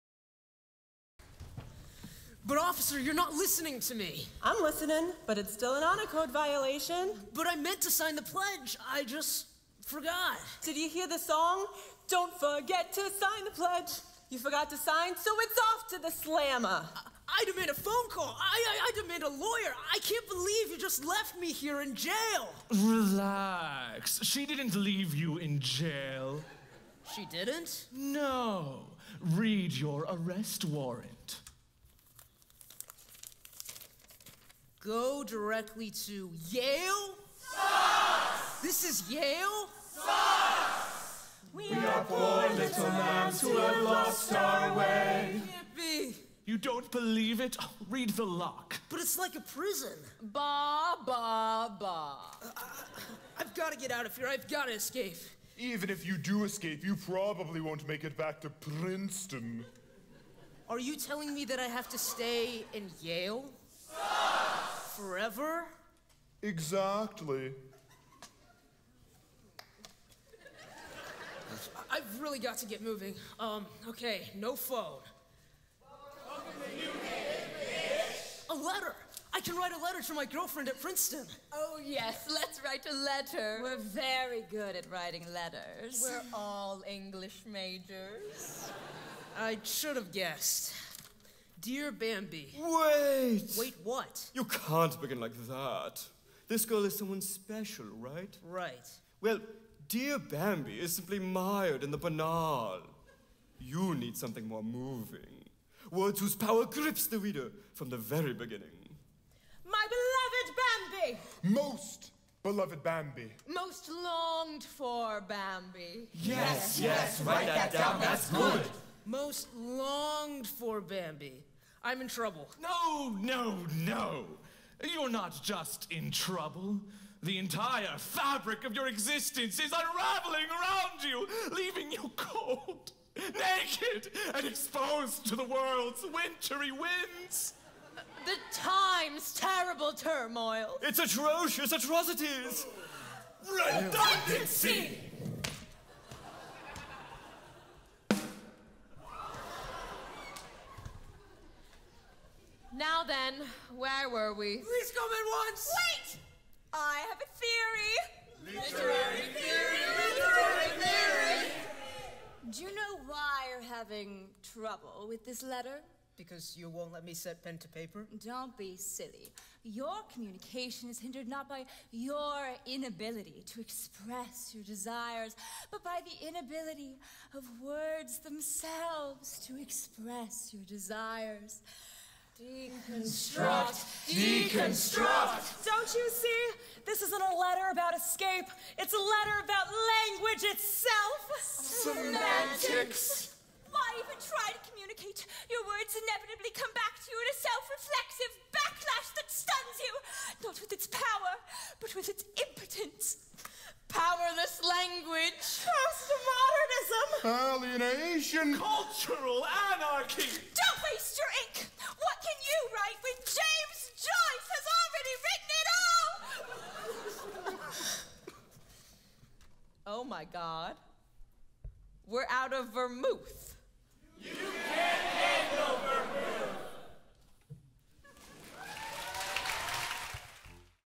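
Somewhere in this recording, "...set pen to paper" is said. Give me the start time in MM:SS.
02:47.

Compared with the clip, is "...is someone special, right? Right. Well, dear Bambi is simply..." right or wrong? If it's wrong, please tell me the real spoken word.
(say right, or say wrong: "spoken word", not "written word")
right.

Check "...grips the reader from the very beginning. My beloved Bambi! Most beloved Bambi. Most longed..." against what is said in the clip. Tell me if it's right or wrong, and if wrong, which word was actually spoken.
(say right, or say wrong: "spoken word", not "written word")
right.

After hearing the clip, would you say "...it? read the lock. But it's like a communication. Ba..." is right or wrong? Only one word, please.
wrong.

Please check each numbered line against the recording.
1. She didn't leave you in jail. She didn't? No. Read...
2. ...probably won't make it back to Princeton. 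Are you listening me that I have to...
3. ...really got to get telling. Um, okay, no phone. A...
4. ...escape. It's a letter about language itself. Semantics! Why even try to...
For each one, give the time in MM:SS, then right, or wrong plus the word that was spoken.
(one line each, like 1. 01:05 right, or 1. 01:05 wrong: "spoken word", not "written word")
1. 00:24 right
2. 00:56 wrong: "telling", not "listening"
3. 01:12 wrong: "moving", not "telling"
4. 03:07 right.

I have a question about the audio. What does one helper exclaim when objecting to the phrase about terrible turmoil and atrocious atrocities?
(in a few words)
Redundancy.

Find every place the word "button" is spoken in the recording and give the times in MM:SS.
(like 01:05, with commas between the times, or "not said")
not said.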